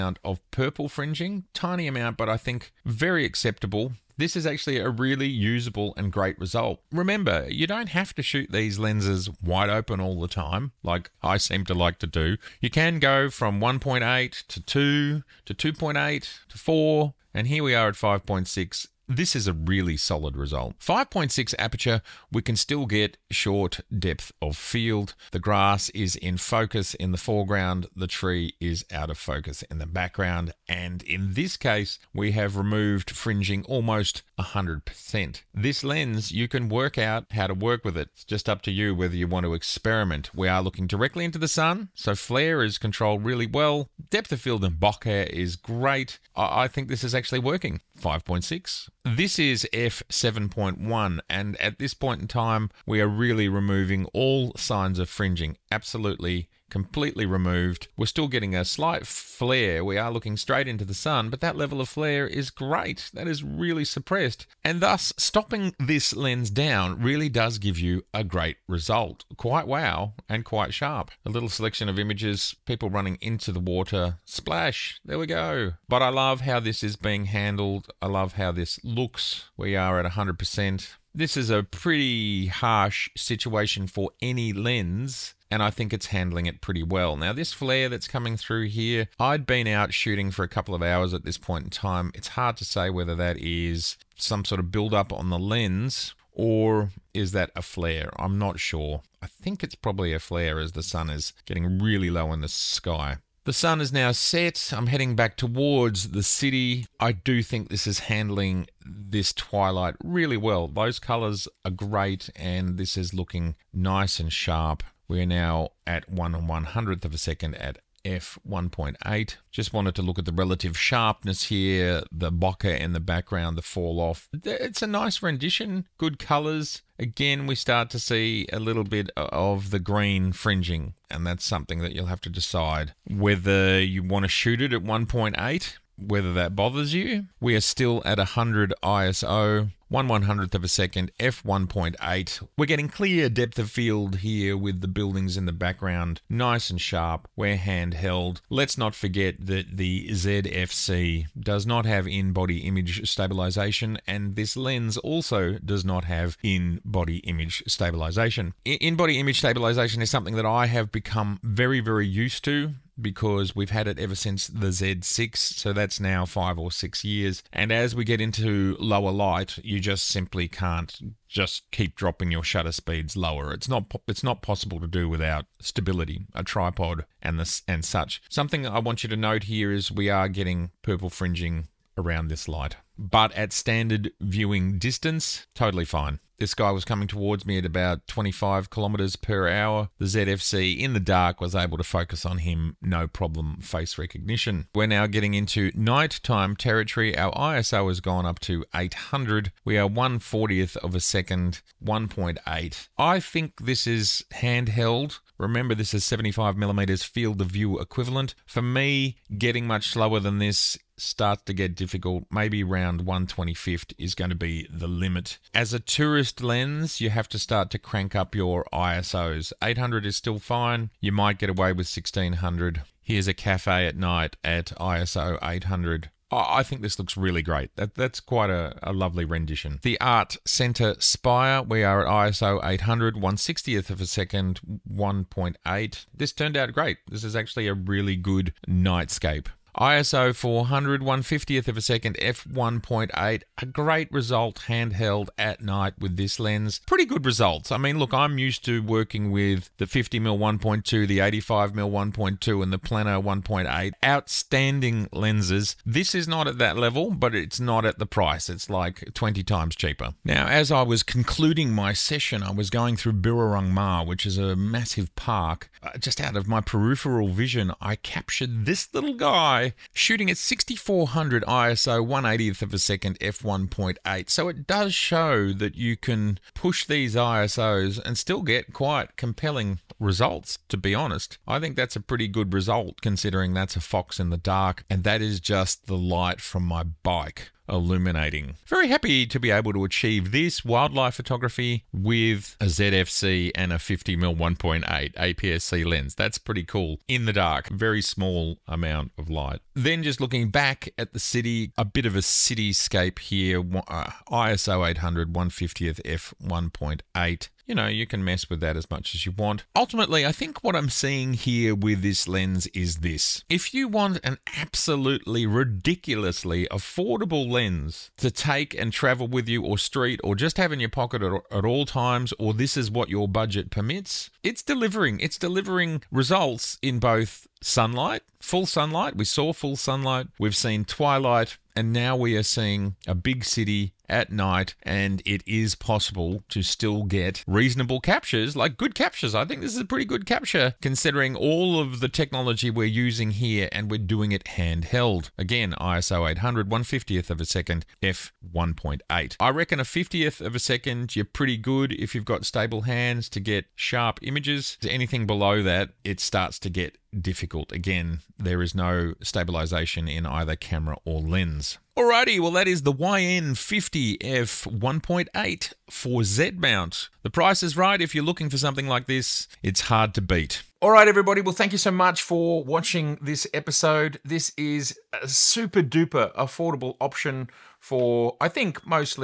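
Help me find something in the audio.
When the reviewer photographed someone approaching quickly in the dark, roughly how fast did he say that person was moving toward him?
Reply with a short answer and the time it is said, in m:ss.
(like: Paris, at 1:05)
25 km/h, at 3:08.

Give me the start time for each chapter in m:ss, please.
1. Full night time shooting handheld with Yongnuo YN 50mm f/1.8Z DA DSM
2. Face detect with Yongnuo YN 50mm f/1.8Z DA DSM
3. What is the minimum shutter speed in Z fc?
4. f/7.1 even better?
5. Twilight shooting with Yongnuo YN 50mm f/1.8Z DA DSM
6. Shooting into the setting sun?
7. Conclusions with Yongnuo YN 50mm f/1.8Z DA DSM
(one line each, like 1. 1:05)
1. 3:16
2. 3:06
3. 5:51
4. 0:48
5. 2:16
6. 1:16
7. 5:08.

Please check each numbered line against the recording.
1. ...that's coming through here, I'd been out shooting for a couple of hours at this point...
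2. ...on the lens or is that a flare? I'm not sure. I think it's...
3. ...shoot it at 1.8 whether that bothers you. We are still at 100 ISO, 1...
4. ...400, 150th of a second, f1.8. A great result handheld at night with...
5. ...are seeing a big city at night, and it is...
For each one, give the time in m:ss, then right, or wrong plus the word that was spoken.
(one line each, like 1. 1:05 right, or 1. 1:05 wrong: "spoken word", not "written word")
1. 1:27 right
2. 1:35 right
3. 2:14 right
4. 4:00 right
5. 5:32 right.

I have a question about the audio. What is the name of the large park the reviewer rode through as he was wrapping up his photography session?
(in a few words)
Birrarung Marr.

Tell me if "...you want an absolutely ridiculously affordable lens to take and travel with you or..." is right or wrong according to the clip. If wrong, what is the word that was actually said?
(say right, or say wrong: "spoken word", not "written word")
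right.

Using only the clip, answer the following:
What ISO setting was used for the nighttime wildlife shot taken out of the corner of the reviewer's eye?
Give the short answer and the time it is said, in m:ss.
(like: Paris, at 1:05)
6400, at 4:30.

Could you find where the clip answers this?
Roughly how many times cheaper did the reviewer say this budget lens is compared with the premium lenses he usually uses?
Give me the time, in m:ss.
4:19.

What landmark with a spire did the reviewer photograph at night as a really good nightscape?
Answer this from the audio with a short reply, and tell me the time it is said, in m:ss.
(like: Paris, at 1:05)
The Art Center, at 3:49.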